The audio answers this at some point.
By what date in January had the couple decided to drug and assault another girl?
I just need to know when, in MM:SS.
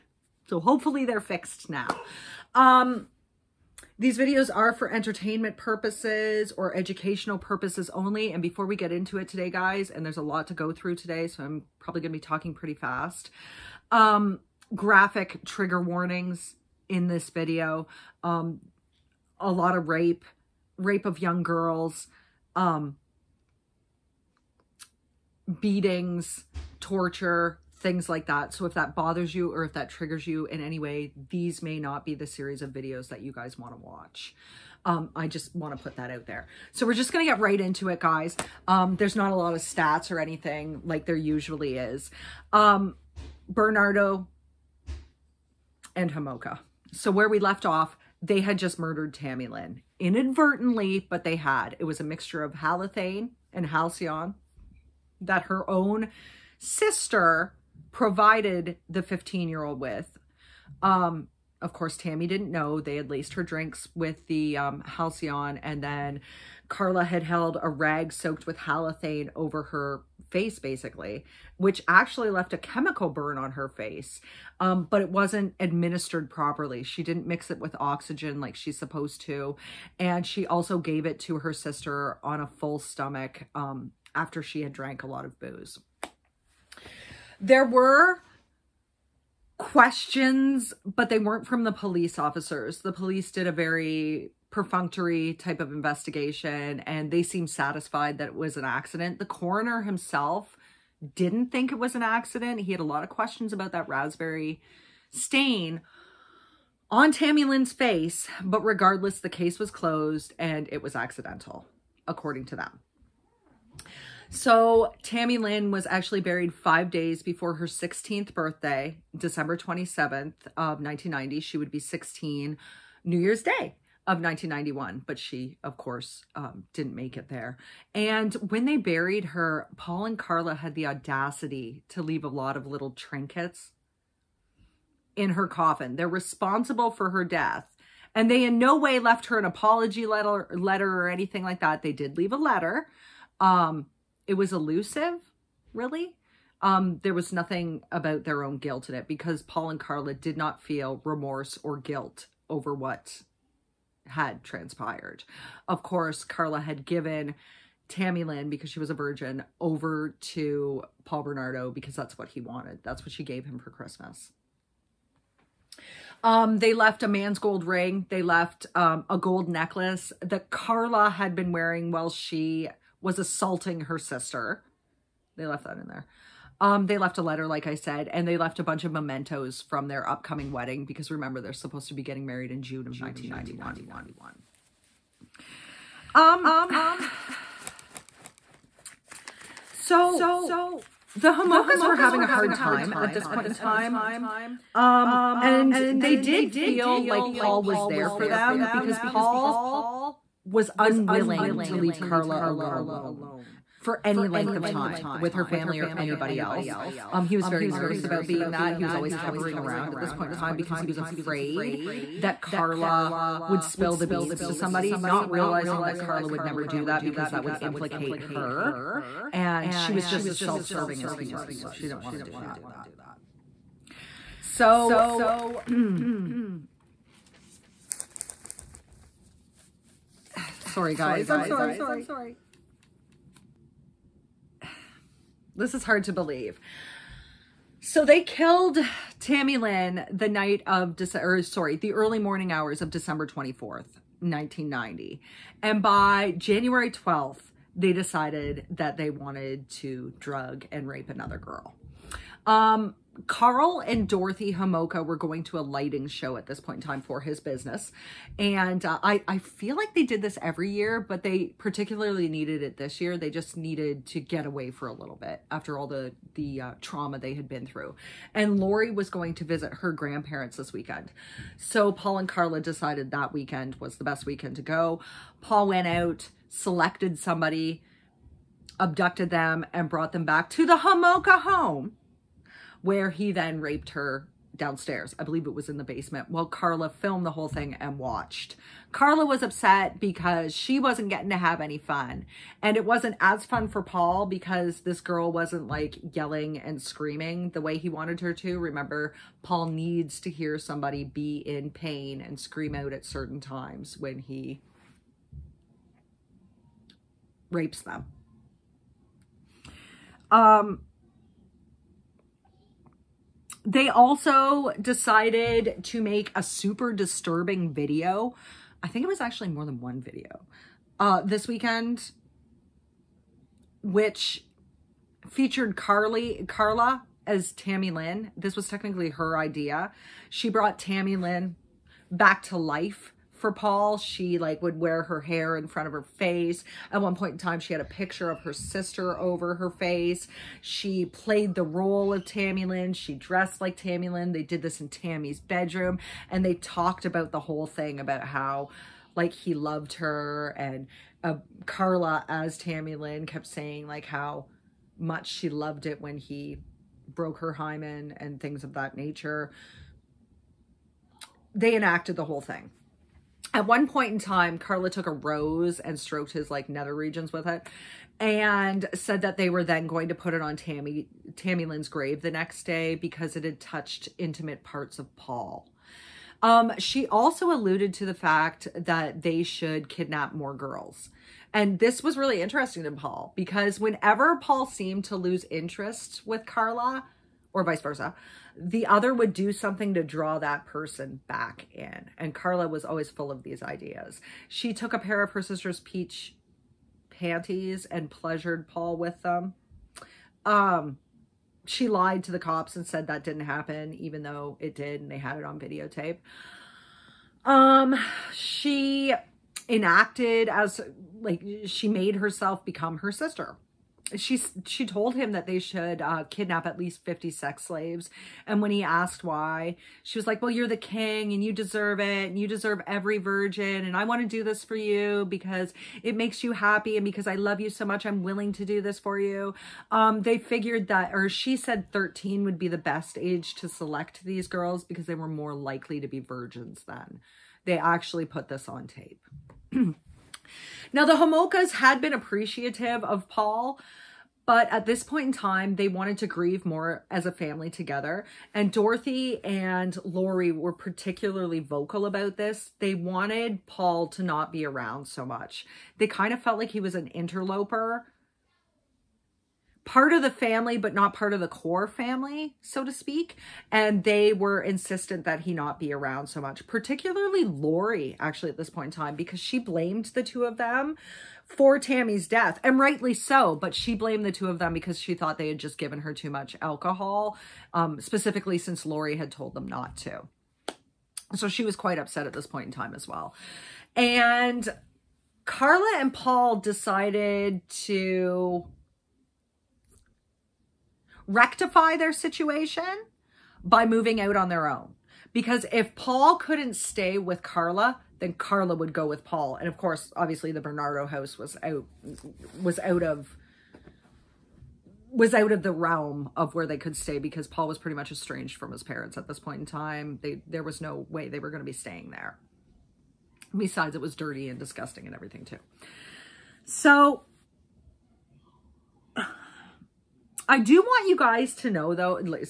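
04:06.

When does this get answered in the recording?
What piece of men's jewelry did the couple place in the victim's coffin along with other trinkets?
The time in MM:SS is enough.
02:47.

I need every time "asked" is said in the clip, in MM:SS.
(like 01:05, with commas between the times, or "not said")
06:58.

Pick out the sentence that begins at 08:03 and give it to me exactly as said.
And Karla and Paul decided to rectify their situation by moving out on their own.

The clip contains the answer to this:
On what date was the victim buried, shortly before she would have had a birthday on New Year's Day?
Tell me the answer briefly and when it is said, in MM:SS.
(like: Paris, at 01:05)
December 27th of 1990, at 01:59.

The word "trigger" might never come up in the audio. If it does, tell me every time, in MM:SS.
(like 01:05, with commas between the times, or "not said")
00:15, 00:29.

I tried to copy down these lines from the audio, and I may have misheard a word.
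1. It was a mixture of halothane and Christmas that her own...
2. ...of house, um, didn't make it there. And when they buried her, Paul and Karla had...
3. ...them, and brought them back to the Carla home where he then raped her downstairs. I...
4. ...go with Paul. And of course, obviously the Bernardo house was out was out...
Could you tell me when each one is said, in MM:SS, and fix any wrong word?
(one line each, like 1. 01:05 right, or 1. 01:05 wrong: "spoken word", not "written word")
1. 00:51 wrong: "Halcion", not "Christmas"
2. 02:05 wrong: "course", not "house"
3. 04:39 wrong: "Homolka", not "Carla"
4. 08:18 right.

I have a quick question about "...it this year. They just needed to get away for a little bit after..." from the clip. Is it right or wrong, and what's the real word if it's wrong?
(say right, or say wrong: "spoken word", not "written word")
right.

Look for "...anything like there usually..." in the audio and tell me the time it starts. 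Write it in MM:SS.
00:40.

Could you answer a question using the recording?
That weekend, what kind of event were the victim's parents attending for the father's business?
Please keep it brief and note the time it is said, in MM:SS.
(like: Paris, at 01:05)
lighting show, at 04:15.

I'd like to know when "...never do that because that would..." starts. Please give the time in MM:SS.
03:36.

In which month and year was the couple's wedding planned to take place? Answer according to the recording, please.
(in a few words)
June of 1991.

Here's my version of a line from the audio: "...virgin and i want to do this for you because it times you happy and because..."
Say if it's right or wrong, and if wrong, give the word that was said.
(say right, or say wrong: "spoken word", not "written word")
wrong: "makes", not "times".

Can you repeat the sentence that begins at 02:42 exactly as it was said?
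That's what she gave him for Christmas.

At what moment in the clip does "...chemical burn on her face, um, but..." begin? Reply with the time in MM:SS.
01:12.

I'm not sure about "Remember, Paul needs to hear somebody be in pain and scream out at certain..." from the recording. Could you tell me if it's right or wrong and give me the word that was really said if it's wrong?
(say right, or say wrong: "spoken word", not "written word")
right.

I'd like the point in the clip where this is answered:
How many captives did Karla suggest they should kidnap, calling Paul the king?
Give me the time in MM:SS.
06:57.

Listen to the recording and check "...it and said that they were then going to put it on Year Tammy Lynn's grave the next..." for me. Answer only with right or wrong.
wrong.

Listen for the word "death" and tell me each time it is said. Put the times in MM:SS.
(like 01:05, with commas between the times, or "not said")
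02:17, 07:52.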